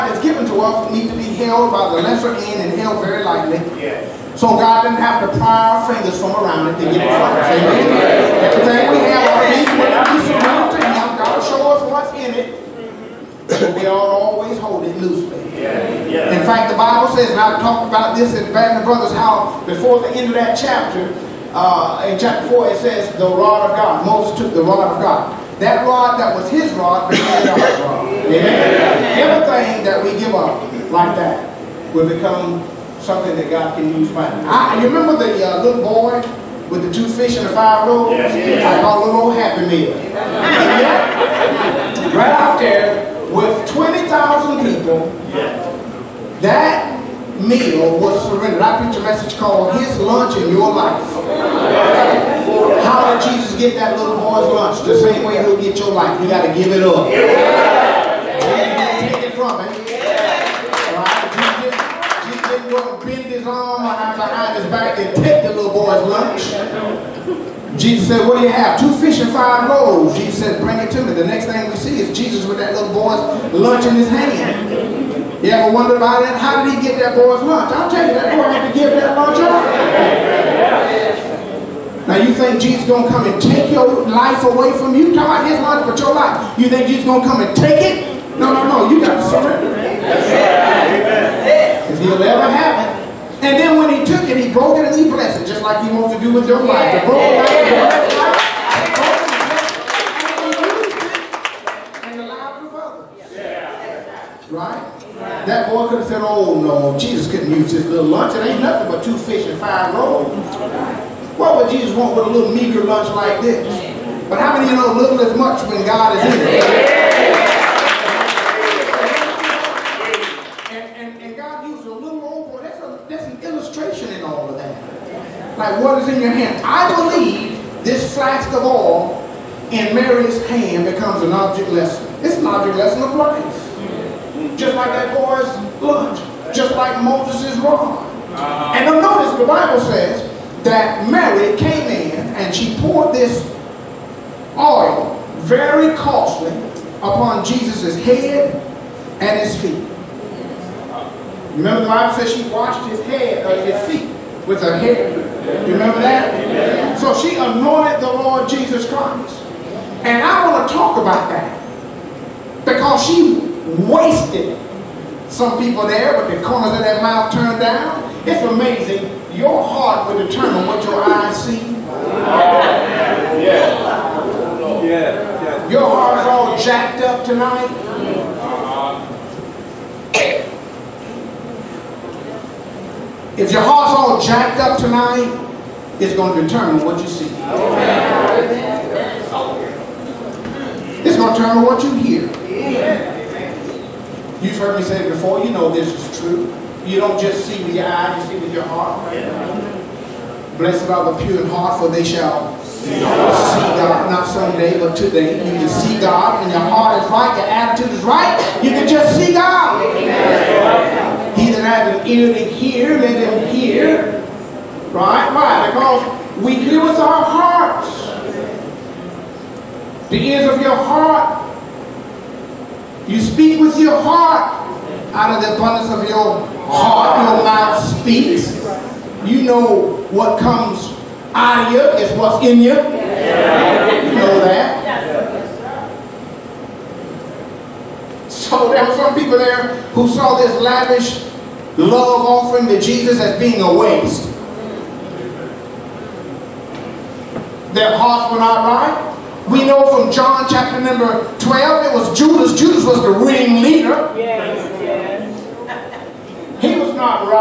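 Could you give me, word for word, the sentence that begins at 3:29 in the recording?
He that has an ear to hear, let him hear.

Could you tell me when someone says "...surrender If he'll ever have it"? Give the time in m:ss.
1:29.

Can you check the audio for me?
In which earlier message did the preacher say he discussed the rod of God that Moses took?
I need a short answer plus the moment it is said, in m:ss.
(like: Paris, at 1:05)
Band of Brothers, at 0:18.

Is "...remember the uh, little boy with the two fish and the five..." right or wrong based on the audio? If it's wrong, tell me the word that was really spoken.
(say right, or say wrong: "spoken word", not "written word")
right.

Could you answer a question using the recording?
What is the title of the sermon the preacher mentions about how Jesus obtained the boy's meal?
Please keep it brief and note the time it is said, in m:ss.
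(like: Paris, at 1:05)
His Lunch in Your Life, at 0:49.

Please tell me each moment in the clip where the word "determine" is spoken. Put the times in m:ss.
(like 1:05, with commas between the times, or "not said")
2:50, 3:06, 3:11.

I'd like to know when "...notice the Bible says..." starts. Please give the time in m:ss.
2:19.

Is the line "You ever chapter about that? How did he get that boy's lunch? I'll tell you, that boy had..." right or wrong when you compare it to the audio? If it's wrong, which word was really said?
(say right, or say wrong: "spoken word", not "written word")
wrong: "wonder", not "chapter".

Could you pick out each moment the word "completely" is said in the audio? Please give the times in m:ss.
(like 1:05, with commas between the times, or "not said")
not said.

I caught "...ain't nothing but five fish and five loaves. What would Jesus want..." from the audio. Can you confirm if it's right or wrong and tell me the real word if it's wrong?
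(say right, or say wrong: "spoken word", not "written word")
wrong: "two", not "five".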